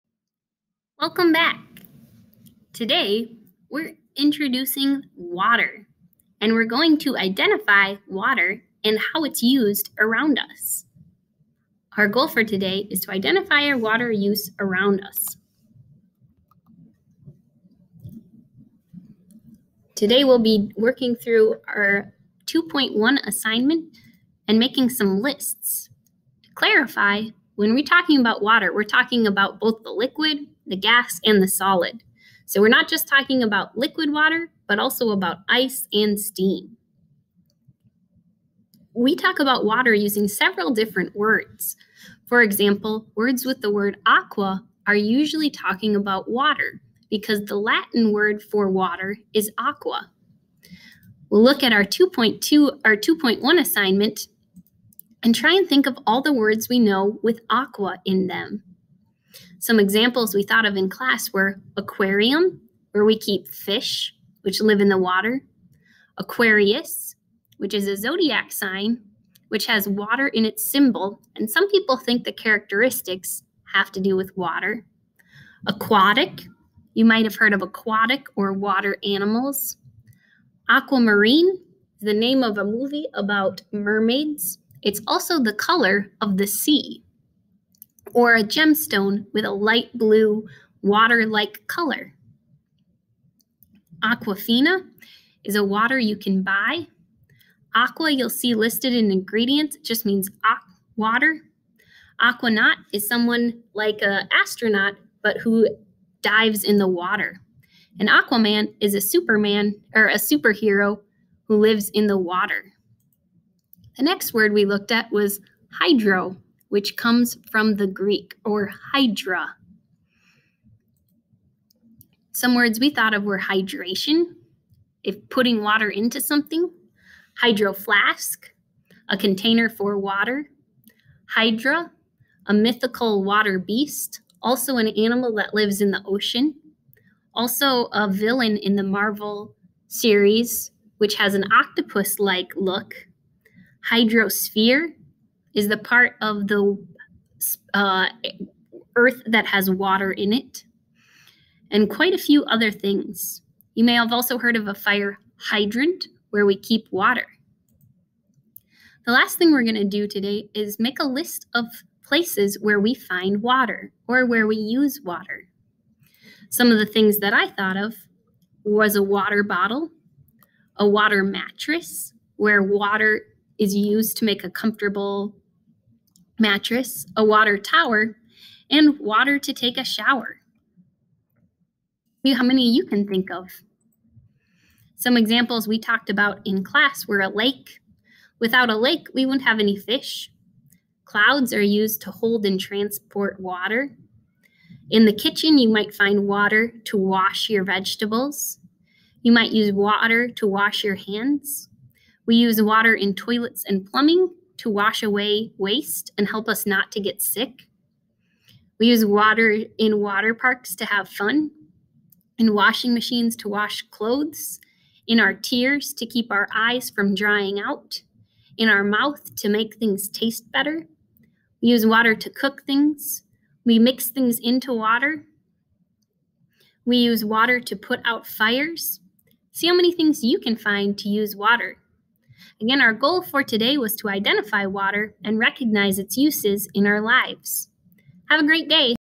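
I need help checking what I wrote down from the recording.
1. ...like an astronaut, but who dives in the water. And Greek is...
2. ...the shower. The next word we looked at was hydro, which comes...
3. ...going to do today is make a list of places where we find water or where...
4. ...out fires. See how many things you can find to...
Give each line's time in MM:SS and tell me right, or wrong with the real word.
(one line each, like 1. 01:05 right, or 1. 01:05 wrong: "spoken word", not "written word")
1. 01:43 wrong: "Aquaman", not "Greek"
2. 01:52 wrong: "water", not "shower"
3. 02:39 right
4. 03:48 right.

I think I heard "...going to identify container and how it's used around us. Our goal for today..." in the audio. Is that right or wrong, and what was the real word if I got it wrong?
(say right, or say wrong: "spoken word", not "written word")
wrong: "water", not "container".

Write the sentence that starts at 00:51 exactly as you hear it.
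We'll look at our 2.2 our 2.1 assignment and try and think of all the words we know with aqua in them.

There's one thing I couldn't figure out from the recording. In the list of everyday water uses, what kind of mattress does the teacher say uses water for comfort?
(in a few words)
water mattress.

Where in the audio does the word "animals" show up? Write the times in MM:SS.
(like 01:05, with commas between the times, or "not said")
01:19, 02:14.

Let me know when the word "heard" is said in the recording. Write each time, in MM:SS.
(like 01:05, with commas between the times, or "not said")
01:17, 02:34.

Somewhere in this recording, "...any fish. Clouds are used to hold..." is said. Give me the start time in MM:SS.
03:09.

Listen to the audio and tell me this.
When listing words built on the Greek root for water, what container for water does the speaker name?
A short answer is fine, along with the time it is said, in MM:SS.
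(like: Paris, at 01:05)
hydro flask, at 02:07.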